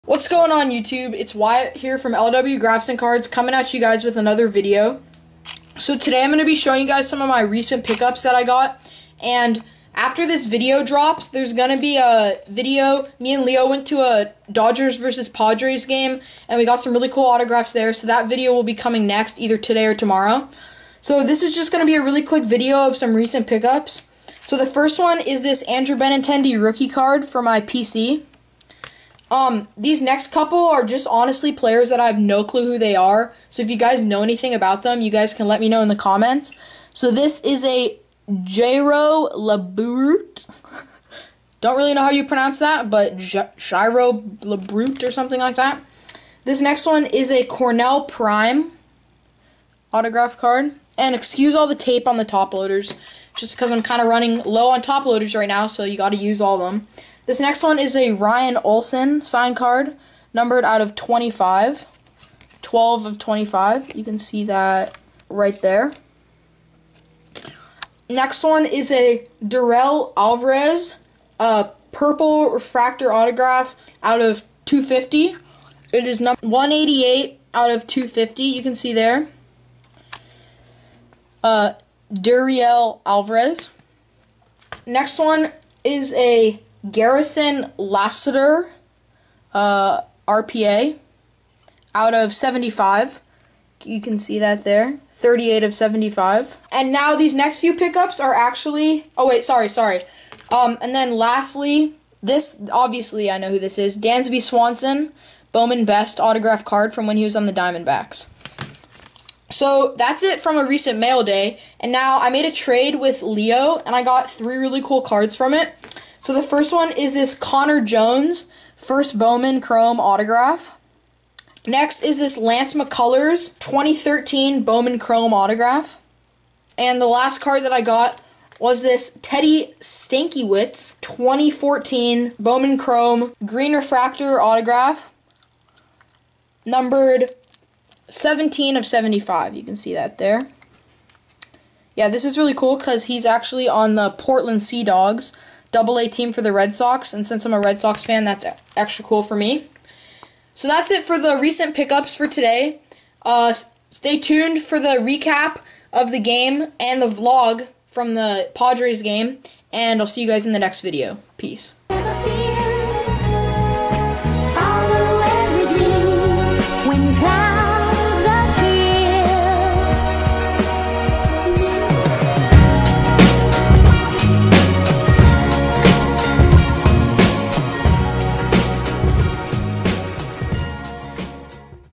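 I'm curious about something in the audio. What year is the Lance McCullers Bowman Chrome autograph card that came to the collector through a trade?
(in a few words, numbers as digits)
2013.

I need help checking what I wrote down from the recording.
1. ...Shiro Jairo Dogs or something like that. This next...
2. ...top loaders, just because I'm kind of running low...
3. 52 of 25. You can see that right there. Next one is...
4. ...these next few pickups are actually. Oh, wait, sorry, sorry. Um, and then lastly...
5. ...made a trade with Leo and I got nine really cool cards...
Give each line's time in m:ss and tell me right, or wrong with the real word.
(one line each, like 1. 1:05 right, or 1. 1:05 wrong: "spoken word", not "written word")
1. 0:43 wrong: "Labrut", not "Dogs"
2. 0:52 right
3. 1:02 wrong: "12", not "52"
4. 1:37 right
5. 1:52 wrong: "three", not "nine".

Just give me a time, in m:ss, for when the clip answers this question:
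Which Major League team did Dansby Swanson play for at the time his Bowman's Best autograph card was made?
1:47.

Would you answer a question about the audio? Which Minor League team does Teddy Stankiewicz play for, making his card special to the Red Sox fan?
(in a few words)
Portland Sea Dogs.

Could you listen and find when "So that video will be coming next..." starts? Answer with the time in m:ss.
0:17.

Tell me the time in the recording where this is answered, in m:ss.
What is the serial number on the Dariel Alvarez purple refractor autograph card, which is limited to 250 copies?
1:16.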